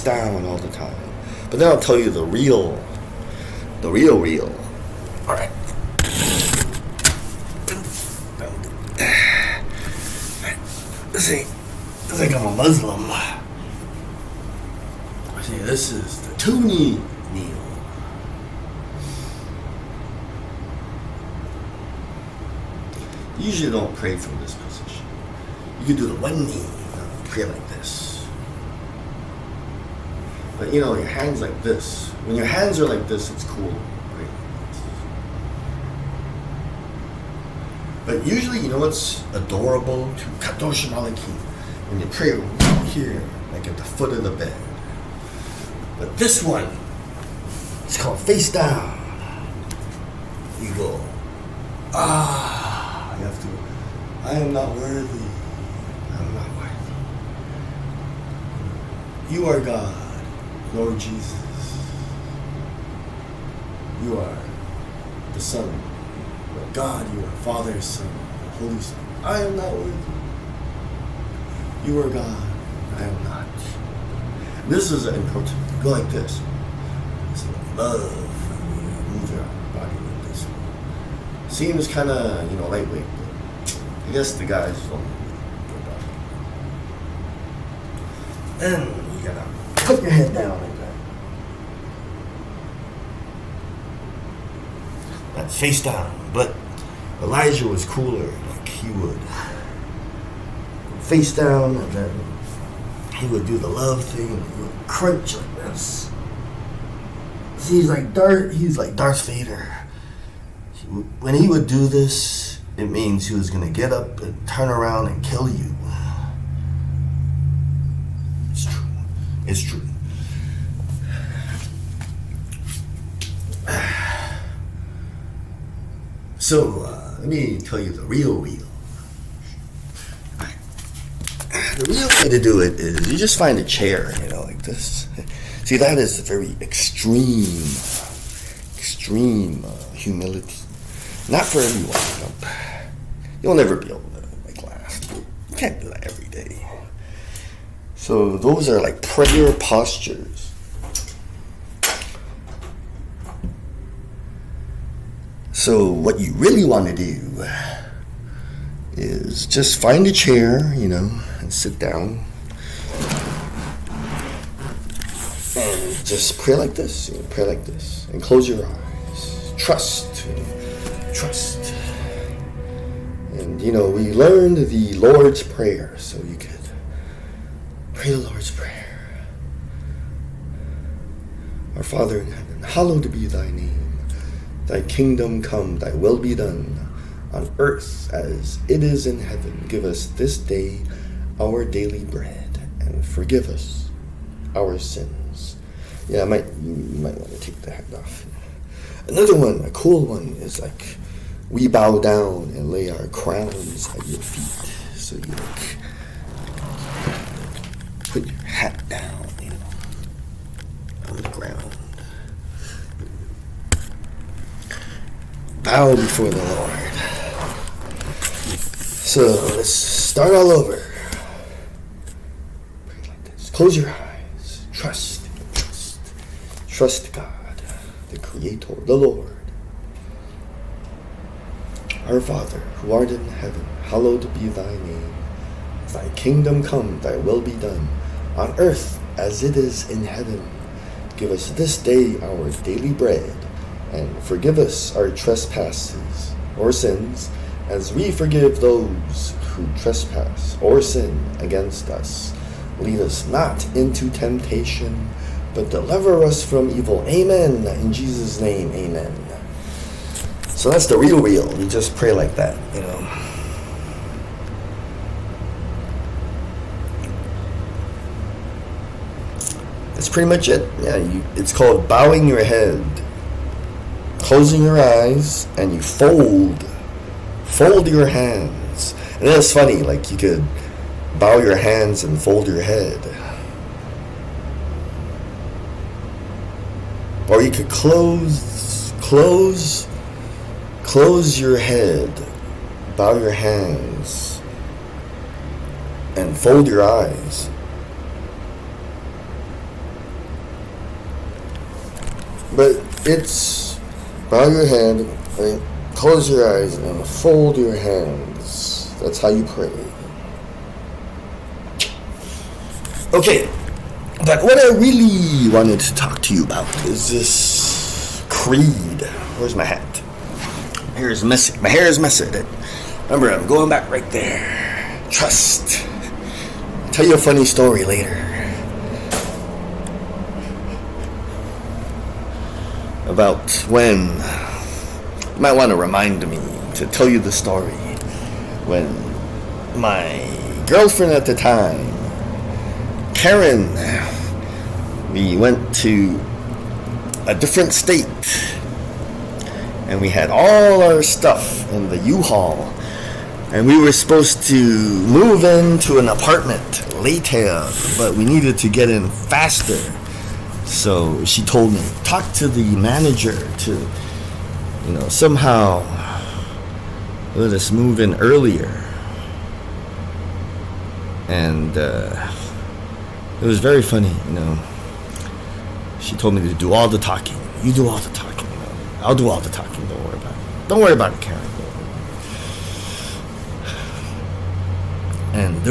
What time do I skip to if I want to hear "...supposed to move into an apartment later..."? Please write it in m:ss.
5:53.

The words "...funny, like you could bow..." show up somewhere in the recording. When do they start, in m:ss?
4:39.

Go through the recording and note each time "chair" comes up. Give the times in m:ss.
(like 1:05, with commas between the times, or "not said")
2:13, 2:40.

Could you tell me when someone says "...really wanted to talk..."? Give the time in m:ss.
5:14.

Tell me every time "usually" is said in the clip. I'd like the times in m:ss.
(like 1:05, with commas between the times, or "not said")
0:23, 0:38.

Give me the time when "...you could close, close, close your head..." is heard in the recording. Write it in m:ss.
4:47.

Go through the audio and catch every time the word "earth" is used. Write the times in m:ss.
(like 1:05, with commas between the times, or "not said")
3:07, 3:58.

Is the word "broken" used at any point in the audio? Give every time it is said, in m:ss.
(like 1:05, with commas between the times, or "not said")
not said.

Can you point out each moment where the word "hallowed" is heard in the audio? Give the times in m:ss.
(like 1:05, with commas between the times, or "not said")
3:02, 3:53.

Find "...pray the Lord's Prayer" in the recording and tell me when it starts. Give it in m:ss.
2:57.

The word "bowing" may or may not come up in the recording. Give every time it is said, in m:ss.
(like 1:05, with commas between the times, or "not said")
4:31.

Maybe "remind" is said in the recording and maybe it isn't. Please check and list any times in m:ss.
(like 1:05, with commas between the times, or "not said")
5:35.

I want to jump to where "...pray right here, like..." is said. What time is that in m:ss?
0:42.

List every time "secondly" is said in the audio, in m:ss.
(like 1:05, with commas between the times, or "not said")
not said.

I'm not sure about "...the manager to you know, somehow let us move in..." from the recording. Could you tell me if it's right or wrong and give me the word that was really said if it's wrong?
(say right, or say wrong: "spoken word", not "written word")
right.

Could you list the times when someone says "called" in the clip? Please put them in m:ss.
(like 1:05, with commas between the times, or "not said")
0:48, 4:31.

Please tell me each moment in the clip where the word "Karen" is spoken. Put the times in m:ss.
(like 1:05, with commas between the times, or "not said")
5:43, 6:21.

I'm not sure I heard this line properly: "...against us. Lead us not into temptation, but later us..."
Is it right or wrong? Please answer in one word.
wrong.